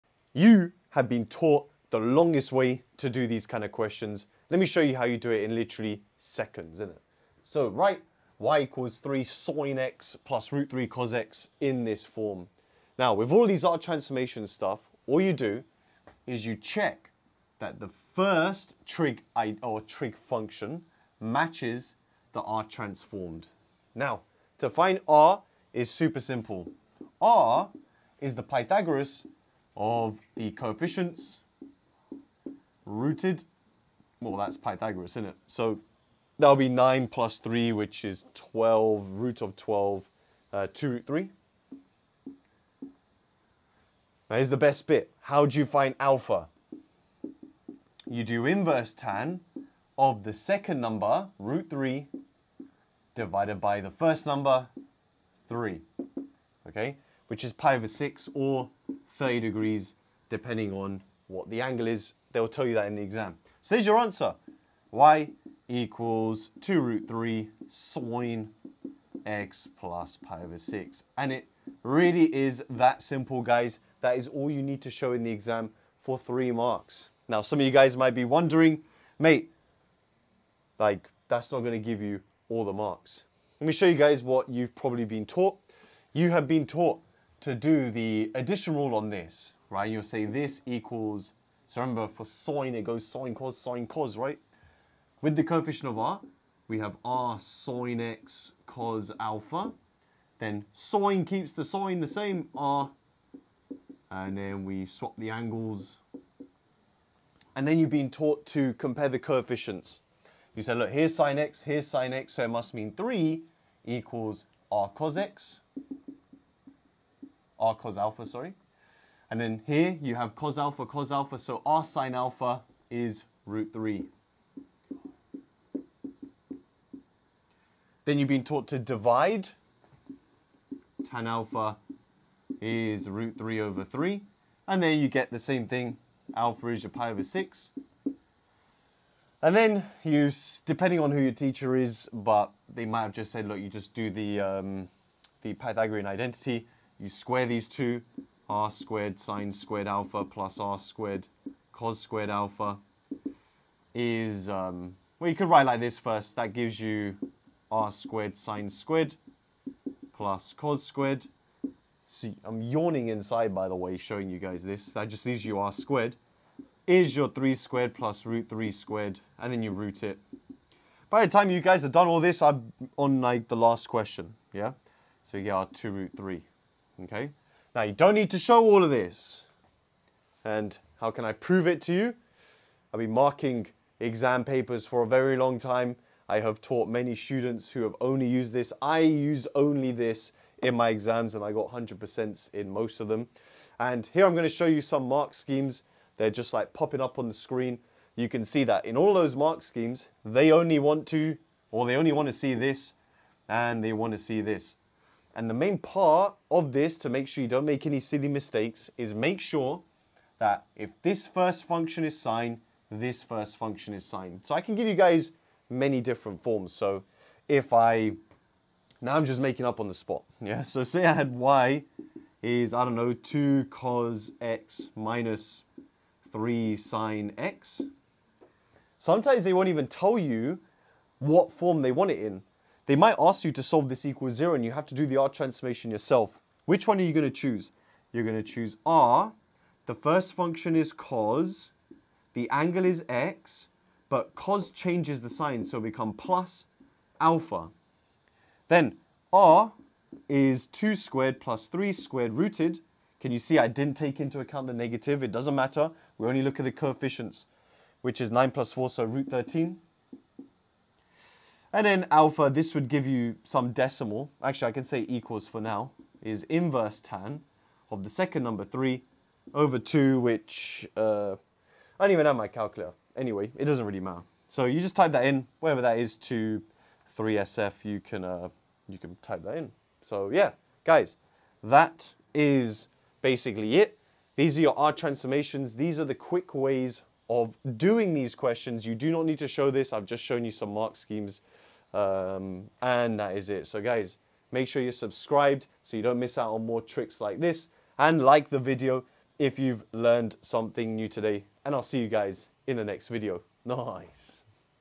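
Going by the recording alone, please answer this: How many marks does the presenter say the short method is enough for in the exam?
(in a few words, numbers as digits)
3.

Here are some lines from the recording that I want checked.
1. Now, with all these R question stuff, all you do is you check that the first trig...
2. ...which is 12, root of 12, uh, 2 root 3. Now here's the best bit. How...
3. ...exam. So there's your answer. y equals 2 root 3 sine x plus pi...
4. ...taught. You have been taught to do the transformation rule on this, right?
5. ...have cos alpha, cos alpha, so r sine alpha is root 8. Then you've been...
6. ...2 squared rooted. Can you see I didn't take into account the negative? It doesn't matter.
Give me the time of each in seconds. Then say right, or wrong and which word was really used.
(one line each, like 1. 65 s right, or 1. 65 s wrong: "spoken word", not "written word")
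1. 12 s wrong: "transformation", not "question"
2. 37 s right
3. 63 s right
4. 85 s wrong: "addition", not "transformation"
5. 120 s wrong: "3", not "8"
6. 251 s wrong: "3", not "2".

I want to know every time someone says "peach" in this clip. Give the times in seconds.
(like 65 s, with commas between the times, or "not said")
not said.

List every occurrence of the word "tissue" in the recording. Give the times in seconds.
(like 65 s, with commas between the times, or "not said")
not said.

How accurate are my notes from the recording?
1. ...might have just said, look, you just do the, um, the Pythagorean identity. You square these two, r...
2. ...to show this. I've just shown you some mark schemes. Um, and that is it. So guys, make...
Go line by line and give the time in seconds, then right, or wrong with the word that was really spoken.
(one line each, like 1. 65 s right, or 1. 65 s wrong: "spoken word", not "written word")
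1. 142 s right
2. 289 s right.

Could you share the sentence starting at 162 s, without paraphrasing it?
See, I'm yawning inside, by the way, showing you guys this.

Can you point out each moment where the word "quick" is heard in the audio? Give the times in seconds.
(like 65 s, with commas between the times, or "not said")
286 s.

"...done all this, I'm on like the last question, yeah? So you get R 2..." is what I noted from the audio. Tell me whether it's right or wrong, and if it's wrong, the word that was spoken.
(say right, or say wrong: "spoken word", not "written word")
right.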